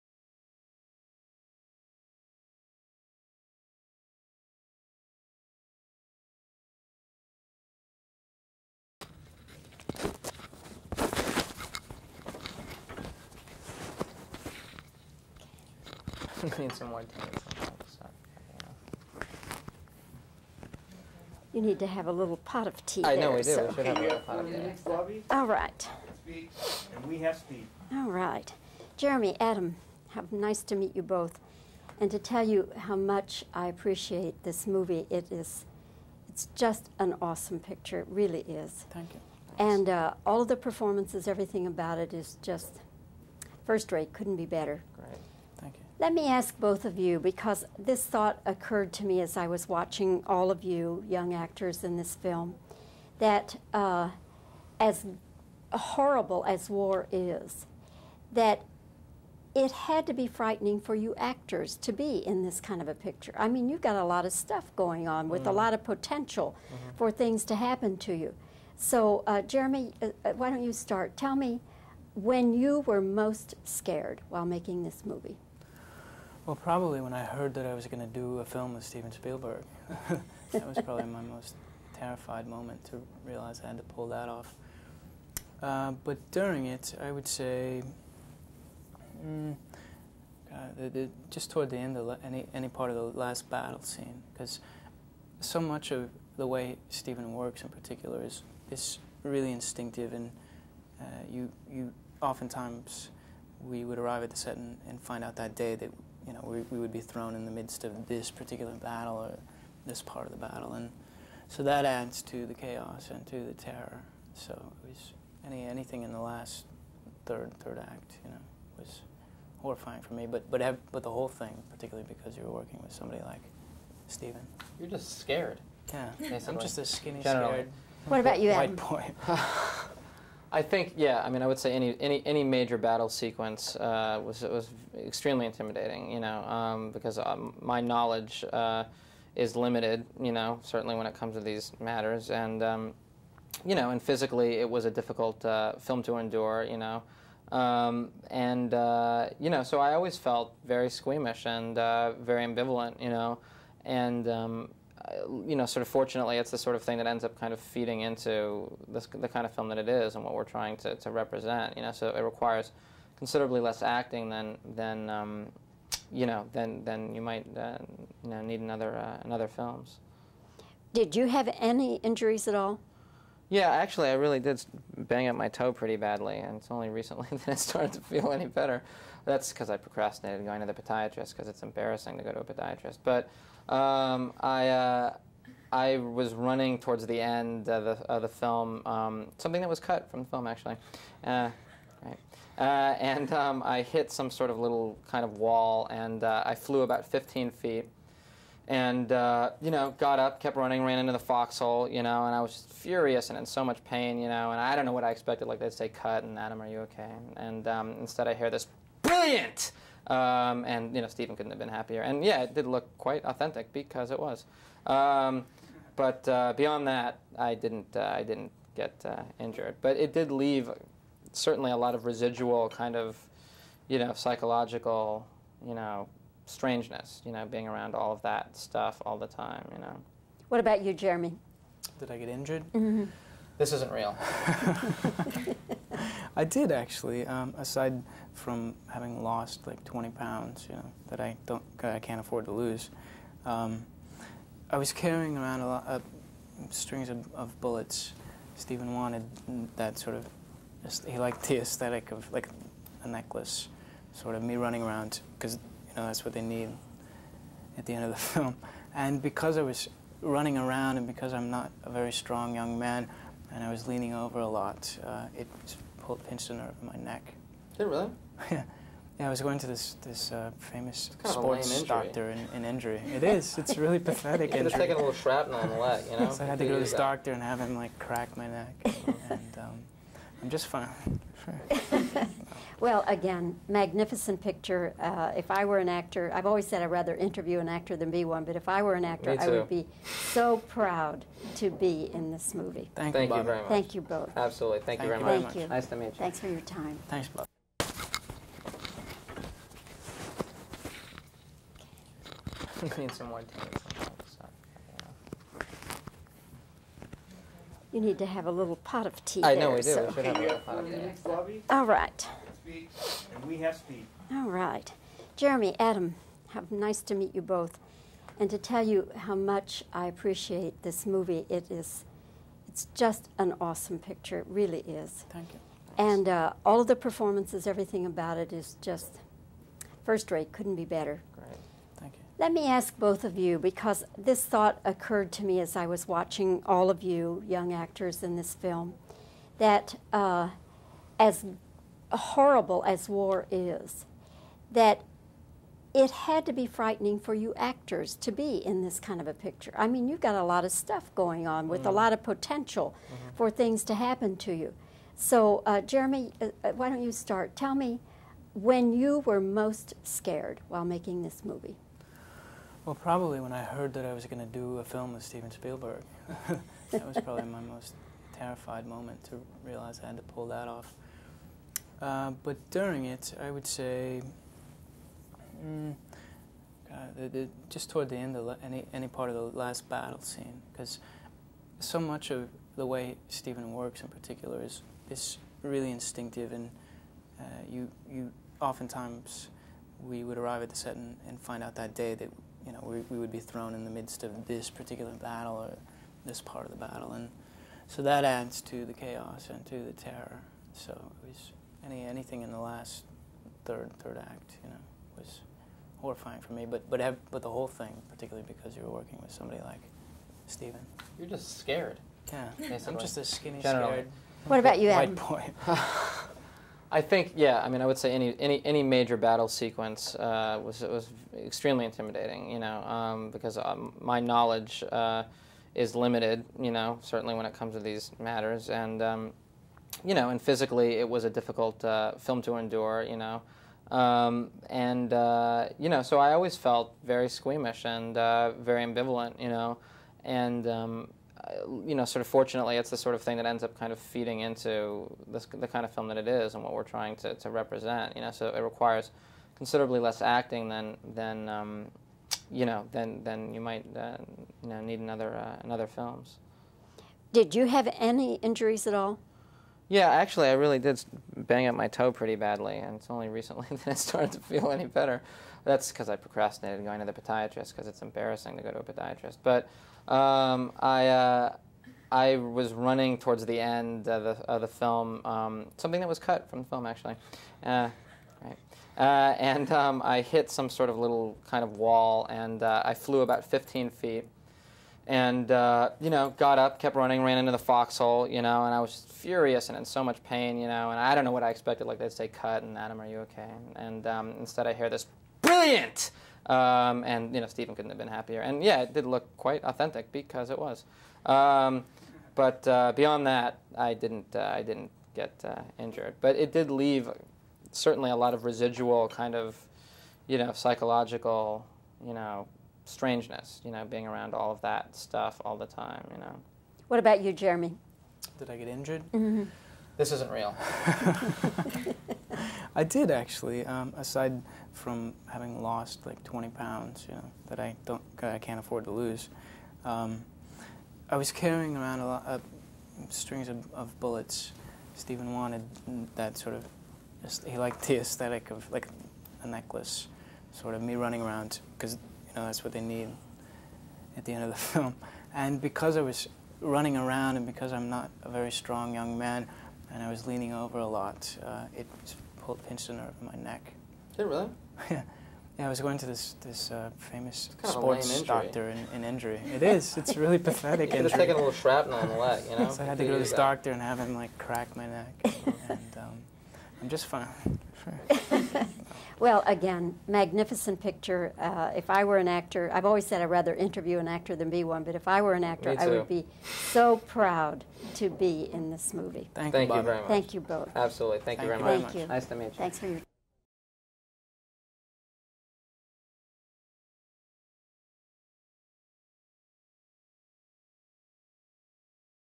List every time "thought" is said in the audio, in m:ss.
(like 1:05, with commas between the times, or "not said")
0:48, 5:34.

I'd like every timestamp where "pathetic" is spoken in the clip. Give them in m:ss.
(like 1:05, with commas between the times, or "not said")
4:33, 9:20.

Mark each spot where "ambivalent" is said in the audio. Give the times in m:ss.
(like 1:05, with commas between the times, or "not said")
2:32, 7:18.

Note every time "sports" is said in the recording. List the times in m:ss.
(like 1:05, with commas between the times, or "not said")
4:31, 9:17.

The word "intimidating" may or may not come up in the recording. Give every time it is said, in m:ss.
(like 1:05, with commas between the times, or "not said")
2:15, 7:01.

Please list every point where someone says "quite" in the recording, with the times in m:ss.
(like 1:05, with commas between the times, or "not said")
3:32, 8:19.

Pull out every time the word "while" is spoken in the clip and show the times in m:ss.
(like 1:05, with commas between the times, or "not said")
1:14, 6:00.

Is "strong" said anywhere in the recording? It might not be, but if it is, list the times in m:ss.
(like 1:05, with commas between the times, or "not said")
4:22, 9:08.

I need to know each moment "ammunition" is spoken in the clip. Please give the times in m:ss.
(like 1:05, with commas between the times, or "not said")
not said.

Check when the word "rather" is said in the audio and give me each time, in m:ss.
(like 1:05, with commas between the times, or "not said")
4:46, 9:33.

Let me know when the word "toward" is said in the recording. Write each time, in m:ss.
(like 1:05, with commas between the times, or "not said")
1:31, 3:06, 6:17, 7:53.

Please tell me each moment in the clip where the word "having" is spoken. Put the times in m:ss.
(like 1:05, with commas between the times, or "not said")
3:58, 8:45.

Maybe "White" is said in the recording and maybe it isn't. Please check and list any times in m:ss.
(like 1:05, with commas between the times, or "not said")
2:08, 6:55.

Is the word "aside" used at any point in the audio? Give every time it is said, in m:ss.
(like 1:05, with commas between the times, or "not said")
3:57, 8:43.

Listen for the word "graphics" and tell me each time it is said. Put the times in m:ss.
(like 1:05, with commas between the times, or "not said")
not said.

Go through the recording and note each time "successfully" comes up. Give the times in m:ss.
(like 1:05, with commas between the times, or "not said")
not said.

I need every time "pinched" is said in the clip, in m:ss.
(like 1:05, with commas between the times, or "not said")
4:26, 9:12.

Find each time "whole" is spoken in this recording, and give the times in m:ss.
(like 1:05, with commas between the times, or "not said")
2:01, 6:47.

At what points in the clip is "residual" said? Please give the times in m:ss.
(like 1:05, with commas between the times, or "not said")
3:42, 8:28.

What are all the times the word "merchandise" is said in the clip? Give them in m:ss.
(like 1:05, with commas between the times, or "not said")
not said.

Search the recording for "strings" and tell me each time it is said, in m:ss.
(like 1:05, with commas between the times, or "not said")
4:06, 8:53.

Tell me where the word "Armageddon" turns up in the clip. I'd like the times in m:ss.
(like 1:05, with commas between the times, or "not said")
not said.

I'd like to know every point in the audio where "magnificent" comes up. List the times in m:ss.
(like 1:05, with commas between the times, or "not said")
4:43, 9:30.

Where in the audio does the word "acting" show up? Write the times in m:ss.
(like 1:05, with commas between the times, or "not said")
2:43, 7:30.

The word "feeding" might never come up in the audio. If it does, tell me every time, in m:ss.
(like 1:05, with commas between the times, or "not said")
2:37, 7:23.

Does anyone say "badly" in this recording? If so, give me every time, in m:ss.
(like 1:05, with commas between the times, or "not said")
2:55, 7:42.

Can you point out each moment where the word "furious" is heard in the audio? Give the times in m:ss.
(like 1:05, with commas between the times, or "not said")
3:22, 8:09.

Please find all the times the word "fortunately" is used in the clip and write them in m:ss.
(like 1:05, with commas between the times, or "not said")
2:35, 7:22.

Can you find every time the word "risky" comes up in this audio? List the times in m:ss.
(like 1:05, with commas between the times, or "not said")
not said.